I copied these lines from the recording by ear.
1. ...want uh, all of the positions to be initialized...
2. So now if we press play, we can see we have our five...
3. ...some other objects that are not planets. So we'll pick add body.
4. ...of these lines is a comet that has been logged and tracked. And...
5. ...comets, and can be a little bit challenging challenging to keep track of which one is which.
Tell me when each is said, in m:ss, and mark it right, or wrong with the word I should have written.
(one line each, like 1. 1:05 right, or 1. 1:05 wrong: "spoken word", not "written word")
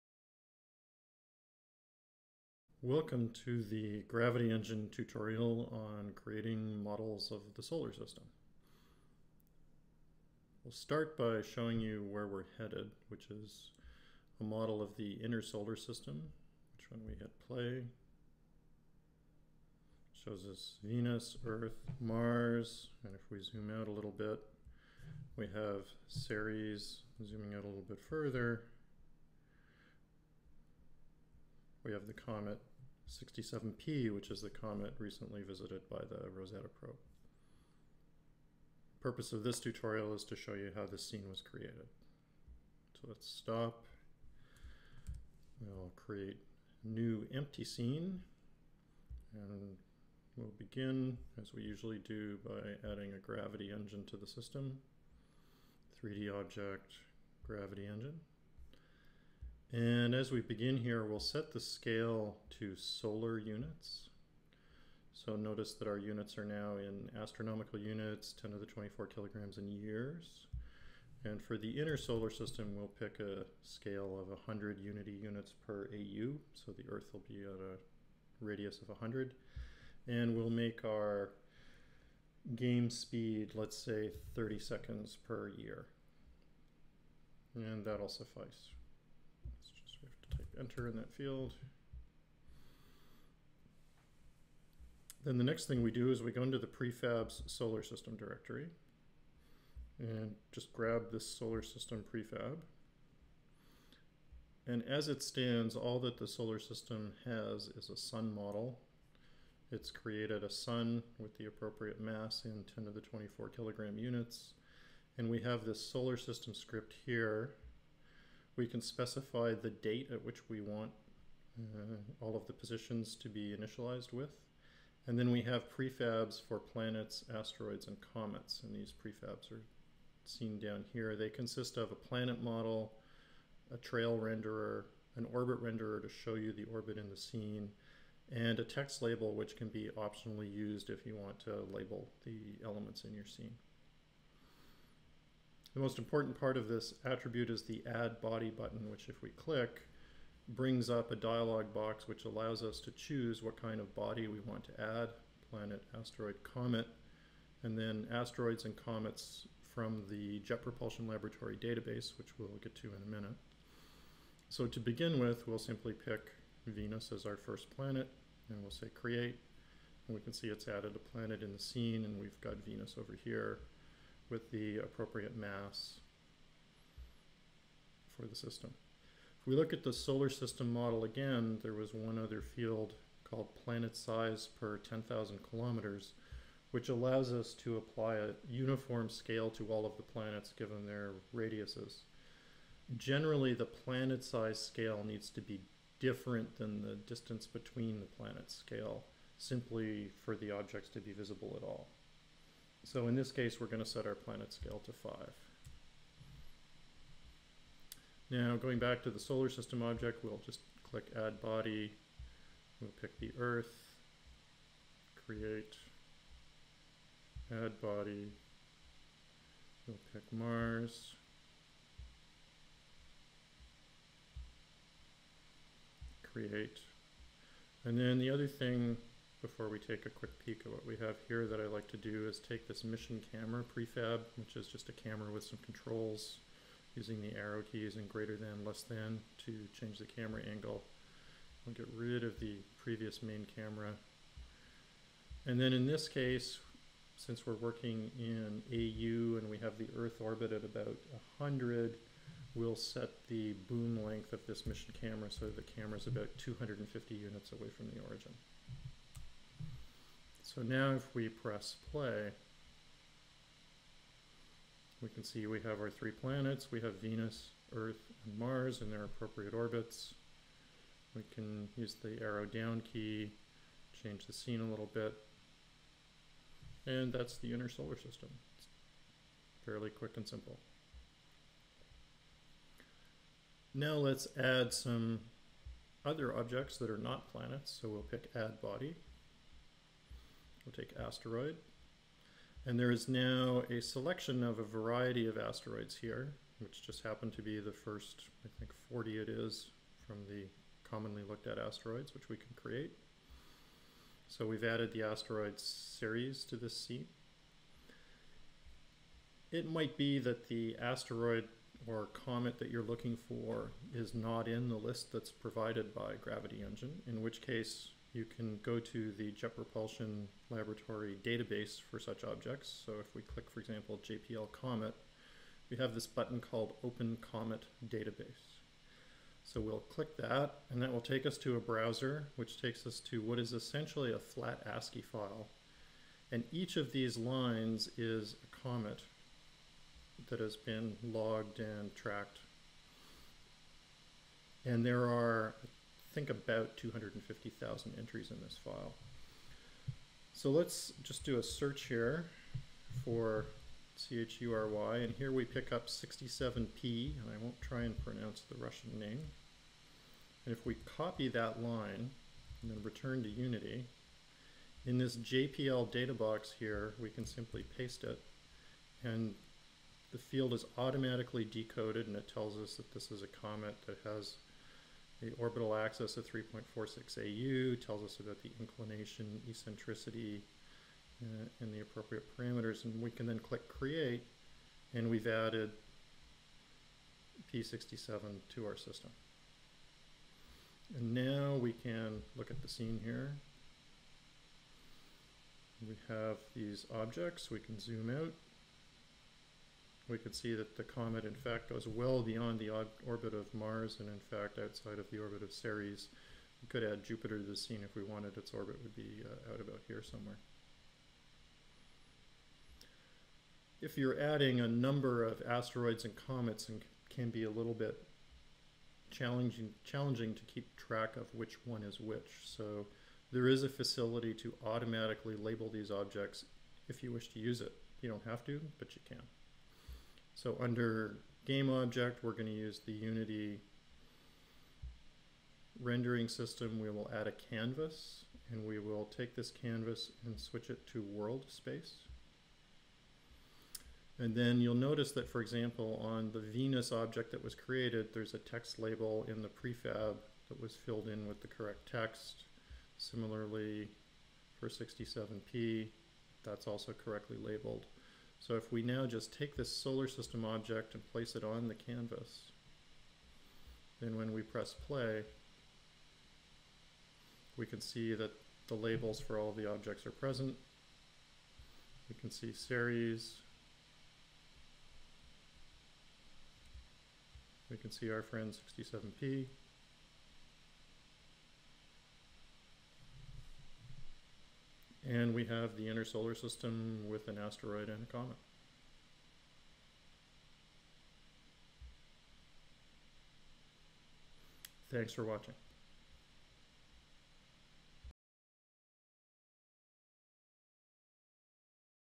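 1. 2:00 right
2. 4:20 wrong: "three", not "five"
3. 4:44 right
4. 5:36 right
5. 6:56 right.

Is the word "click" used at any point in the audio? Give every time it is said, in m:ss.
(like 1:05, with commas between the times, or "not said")
2:29, 3:30, 5:23, 5:29, 6:23.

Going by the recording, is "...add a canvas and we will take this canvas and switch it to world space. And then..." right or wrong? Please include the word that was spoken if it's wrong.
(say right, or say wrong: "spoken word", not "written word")
right.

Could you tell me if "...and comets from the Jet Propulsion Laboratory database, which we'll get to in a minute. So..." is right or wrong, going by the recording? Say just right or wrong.
right.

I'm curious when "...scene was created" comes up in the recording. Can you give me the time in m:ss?
0:41.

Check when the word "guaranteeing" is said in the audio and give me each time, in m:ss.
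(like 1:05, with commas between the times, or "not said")
not said.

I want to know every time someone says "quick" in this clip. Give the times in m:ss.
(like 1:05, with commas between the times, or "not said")
3:50, 4:39.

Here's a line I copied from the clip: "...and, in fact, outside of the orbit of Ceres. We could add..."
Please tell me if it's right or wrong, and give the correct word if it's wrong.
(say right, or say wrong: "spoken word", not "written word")
right.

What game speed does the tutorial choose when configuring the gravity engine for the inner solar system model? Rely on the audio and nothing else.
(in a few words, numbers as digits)
30 seconds per year.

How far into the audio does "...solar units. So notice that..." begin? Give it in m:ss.
1:02.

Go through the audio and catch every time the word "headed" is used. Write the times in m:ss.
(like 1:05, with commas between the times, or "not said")
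0:12.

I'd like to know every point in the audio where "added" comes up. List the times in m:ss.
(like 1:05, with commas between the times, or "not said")
2:50, 5:04, 6:25.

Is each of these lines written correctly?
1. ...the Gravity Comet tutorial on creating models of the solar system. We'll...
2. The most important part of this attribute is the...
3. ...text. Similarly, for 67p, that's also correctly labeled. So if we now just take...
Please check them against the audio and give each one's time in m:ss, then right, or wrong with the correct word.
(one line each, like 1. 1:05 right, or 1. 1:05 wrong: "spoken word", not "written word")
1. 0:03 wrong: "Engine", not "Comet"
2. 2:25 right
3. 7:31 right.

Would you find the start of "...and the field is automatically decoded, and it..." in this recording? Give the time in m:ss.
6:09.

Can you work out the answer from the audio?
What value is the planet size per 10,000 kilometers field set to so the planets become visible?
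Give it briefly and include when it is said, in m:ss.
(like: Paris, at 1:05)
5, at 3:24.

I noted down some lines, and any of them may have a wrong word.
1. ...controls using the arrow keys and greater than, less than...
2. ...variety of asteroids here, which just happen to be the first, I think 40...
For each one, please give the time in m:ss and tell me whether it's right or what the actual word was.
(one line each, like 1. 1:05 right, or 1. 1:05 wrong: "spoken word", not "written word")
1. 3:55 right
2. 4:54 right.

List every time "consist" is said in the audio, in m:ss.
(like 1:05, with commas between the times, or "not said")
2:11.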